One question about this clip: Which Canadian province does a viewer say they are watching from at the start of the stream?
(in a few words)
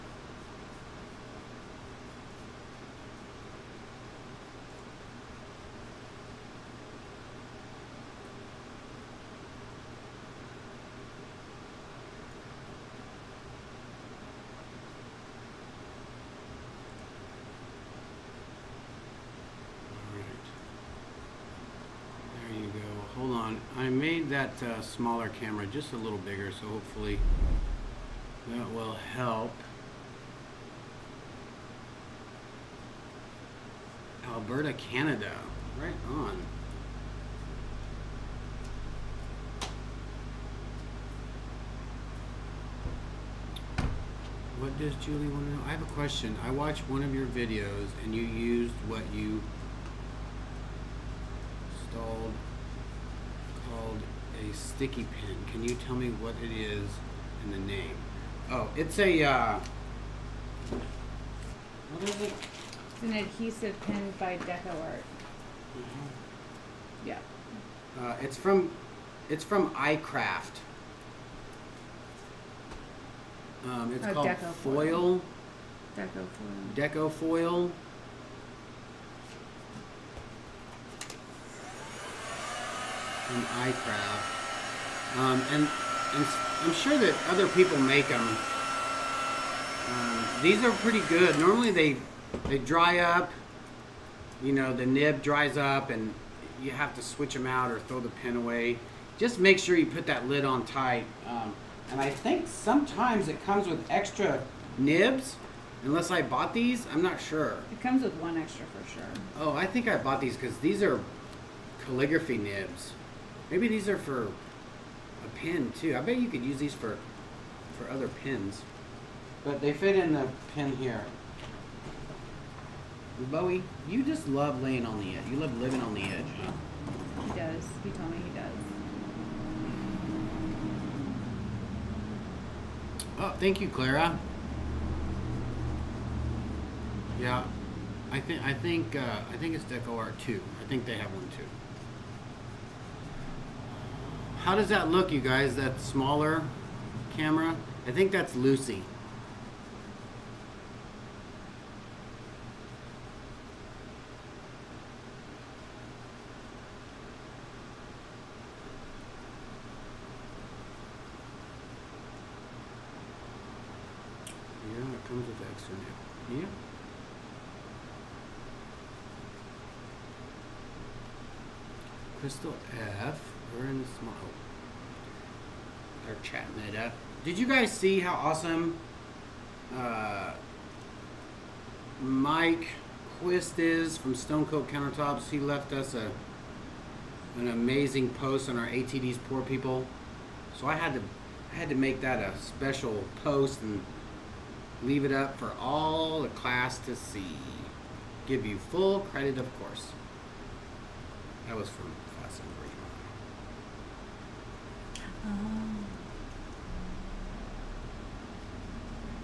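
Alberta.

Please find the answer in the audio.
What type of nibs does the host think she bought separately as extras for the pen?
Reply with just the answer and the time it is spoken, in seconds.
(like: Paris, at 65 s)
Calligraphy nibs, at 111 s.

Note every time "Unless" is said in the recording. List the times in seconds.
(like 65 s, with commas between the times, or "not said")
105 s.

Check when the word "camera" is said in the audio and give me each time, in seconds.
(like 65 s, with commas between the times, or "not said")
25 s, 147 s.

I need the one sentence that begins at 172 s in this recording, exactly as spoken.
crystal F we're in the small.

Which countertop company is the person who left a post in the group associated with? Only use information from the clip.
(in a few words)
Stone Coat Countertops.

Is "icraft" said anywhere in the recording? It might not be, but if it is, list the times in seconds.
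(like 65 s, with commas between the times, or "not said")
69 s, 83 s.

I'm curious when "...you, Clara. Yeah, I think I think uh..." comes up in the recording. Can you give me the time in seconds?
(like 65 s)
133 s.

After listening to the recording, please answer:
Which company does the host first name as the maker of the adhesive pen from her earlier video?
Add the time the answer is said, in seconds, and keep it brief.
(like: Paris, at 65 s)
DecoArt, at 64 s.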